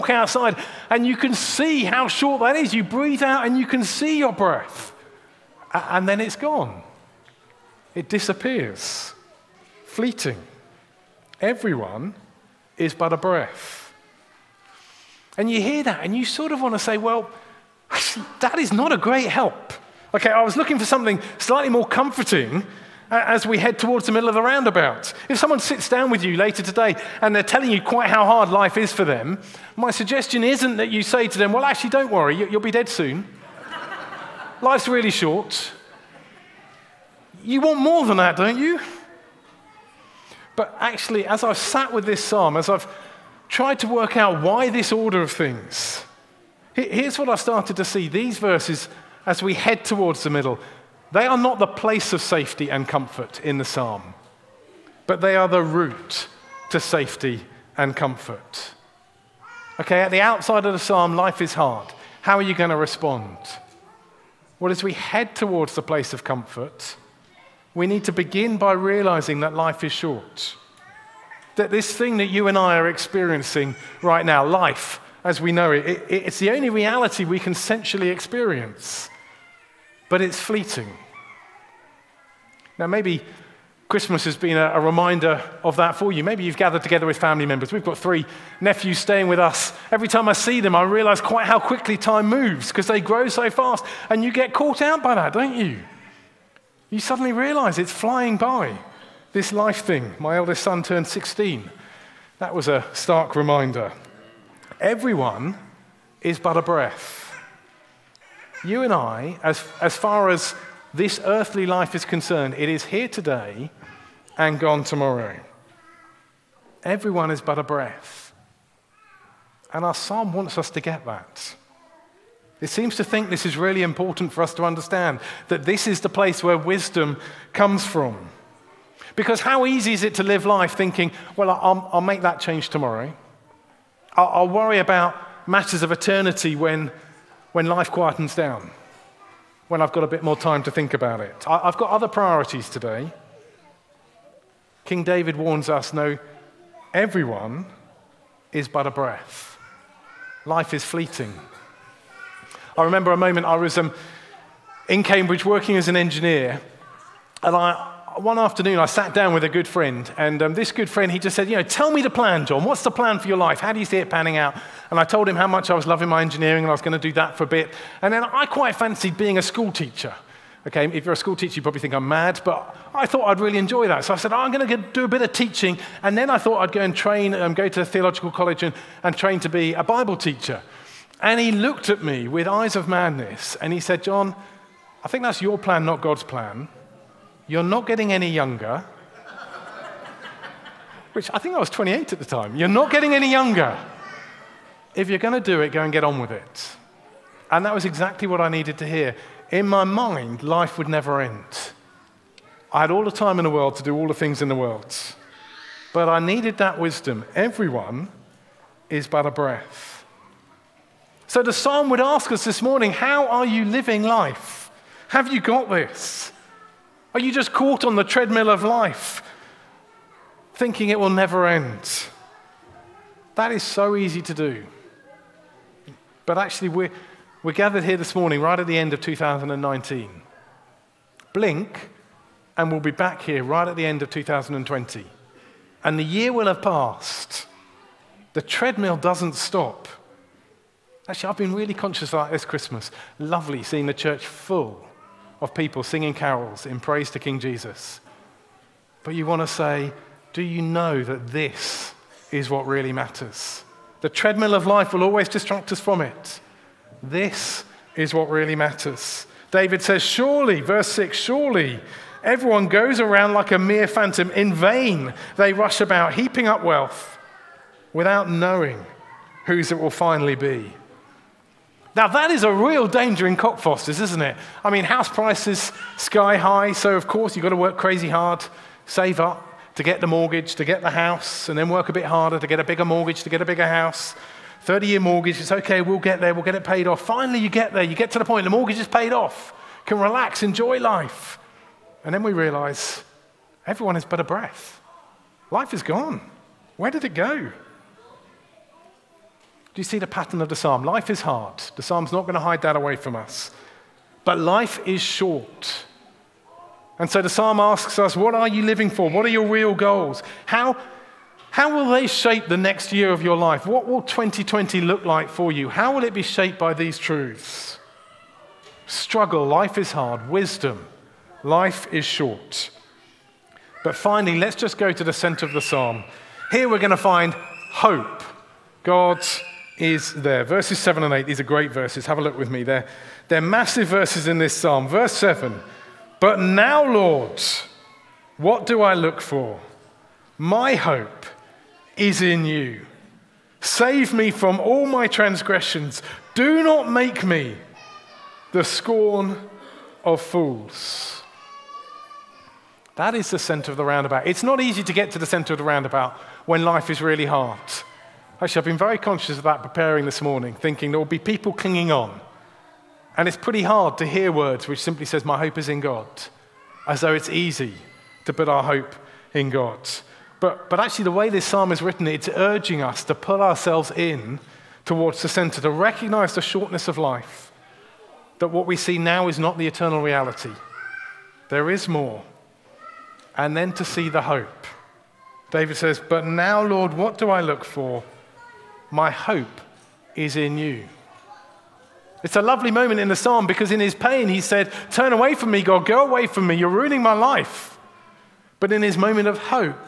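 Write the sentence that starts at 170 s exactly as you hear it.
Okay, if you're a school teacher, you probably think I'm mad, but I thought I'd really enjoy that.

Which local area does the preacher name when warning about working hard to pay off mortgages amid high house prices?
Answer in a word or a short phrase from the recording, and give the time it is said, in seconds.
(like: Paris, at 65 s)
Cockfosters, at 273 s.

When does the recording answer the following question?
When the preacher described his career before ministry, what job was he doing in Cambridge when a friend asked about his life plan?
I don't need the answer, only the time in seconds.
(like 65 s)
155 s.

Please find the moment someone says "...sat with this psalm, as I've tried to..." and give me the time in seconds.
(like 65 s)
41 s.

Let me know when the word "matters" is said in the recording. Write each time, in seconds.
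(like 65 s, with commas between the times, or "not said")
135 s, 252 s, 258 s.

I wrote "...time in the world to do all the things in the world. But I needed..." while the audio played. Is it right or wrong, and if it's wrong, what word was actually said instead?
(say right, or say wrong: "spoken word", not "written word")
right.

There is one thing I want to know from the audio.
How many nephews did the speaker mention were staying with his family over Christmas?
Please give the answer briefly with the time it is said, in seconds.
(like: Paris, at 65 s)
3, at 87 s.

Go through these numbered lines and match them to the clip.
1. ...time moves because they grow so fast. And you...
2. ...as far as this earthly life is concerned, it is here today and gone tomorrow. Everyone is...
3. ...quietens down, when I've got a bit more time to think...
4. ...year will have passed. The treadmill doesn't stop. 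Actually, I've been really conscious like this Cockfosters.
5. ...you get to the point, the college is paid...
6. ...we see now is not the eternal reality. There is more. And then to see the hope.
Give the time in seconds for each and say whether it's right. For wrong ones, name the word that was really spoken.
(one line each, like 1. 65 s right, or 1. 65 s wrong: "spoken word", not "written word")
1. 91 s right
2. 109 s right
3. 137 s right
4. 236 s wrong: "Christmas", not "Cockfosters"
5. 287 s wrong: "mortgage", not "college"
6. 378 s right.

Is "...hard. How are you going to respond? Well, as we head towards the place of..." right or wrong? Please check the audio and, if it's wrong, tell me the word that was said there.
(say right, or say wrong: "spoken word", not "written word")
right.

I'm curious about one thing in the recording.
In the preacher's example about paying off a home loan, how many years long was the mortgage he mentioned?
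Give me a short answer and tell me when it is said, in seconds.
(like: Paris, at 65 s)
30, at 284 s.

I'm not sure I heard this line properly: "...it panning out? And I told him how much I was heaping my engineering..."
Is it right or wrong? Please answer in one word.
wrong.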